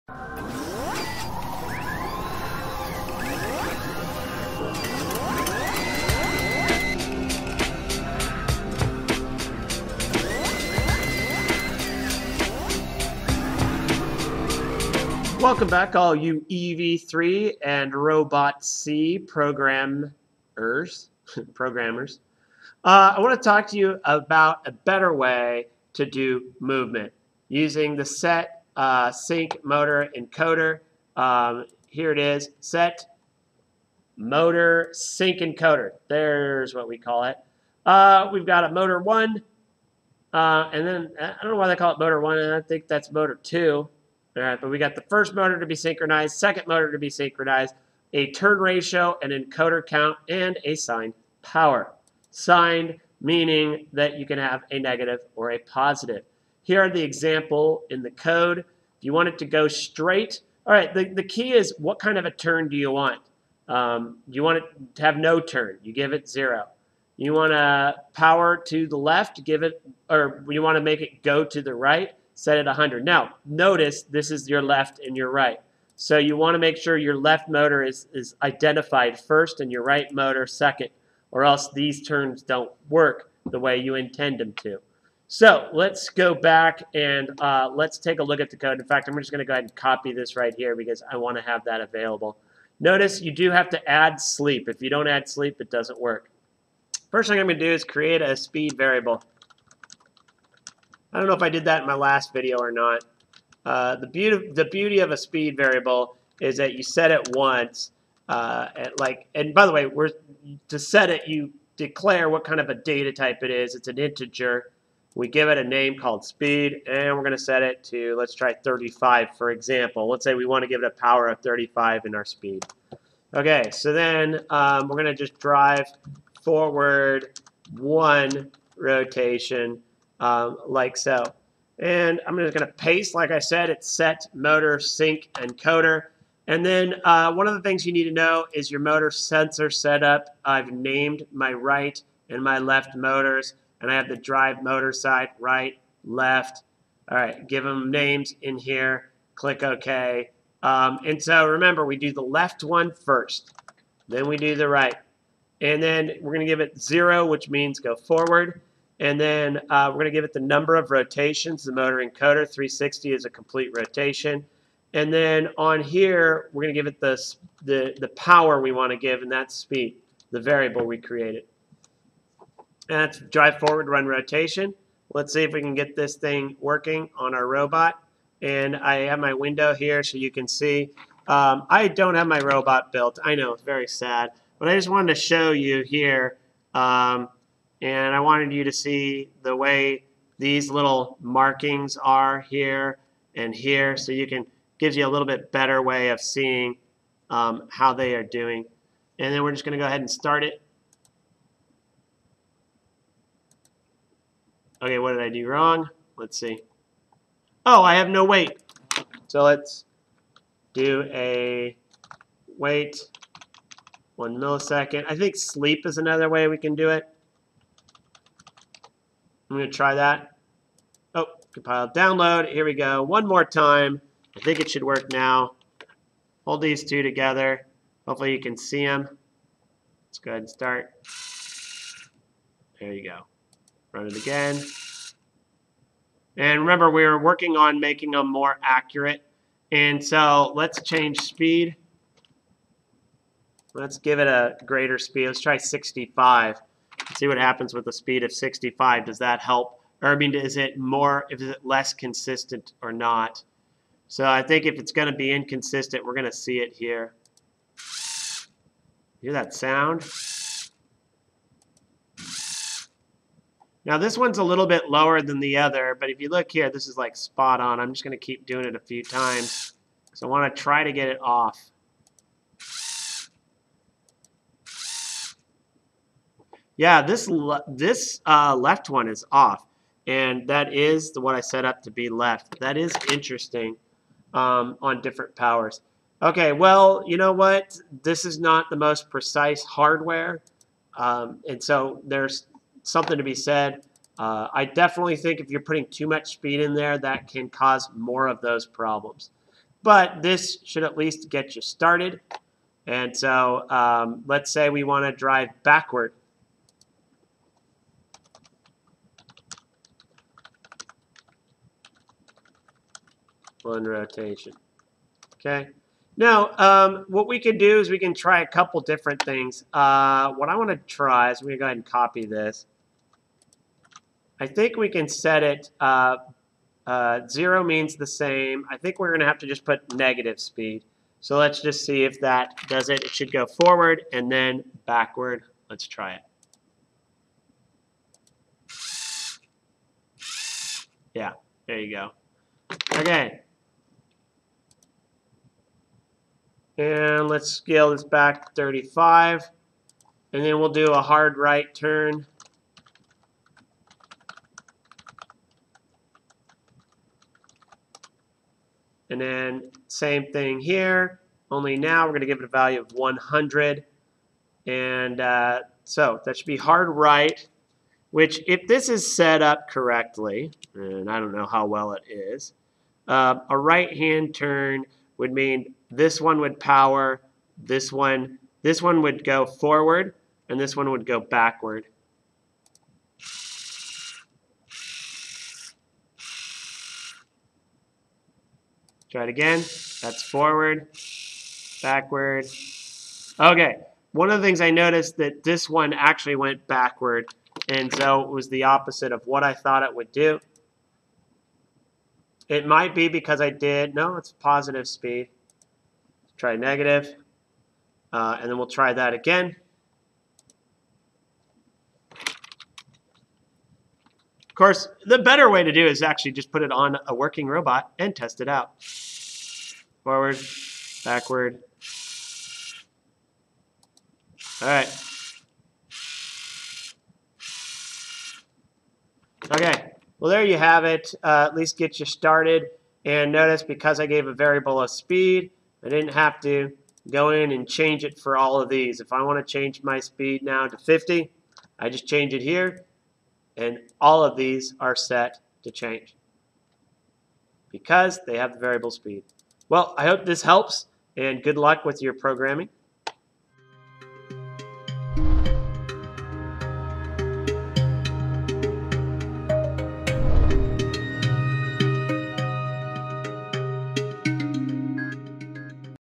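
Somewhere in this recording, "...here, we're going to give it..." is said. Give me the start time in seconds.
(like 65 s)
165 s.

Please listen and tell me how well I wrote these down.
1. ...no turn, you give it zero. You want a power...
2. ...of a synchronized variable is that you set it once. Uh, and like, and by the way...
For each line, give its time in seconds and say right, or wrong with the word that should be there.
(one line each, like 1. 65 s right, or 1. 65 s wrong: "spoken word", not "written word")
1. 65 s right
2. 104 s wrong: "speed", not "synchronized".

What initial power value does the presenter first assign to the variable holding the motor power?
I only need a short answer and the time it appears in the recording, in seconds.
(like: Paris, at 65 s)
35, at 118 s.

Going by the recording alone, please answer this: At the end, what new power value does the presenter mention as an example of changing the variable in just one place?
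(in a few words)
50.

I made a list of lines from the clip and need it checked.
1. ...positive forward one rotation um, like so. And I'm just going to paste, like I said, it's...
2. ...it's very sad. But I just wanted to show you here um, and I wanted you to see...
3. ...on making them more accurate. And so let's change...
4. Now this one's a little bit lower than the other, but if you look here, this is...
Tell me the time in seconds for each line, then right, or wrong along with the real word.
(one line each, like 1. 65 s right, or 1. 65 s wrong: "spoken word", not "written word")
1. 125 s wrong: "drive", not "positive"
2. 183 s right
3. 237 s right
4. 263 s right.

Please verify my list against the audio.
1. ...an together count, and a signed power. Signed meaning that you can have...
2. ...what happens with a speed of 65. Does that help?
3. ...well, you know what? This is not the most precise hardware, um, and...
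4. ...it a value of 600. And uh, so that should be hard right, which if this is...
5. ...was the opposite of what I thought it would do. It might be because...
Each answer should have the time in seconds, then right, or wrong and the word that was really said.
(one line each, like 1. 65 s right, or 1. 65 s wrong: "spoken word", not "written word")
1. 49 s wrong: "encoder", not "together"
2. 247 s right
3. 286 s right
4. 362 s wrong: "100", not "600"
5. 398 s right.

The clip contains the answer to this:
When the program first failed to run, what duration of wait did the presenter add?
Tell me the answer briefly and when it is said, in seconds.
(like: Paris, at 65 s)
1 millisecond, at 214 s.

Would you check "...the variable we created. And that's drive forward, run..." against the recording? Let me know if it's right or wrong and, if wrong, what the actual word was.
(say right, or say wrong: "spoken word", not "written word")
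right.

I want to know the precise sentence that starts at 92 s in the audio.
Notice you do have to add sleep.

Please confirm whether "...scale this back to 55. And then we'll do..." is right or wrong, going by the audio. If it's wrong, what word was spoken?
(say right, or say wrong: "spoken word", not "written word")
wrong: "35", not "55".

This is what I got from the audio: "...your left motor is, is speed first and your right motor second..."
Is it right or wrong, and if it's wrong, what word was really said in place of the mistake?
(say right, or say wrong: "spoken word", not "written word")
wrong: "identified", not "speed".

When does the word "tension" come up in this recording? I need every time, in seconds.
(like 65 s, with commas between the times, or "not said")
not said.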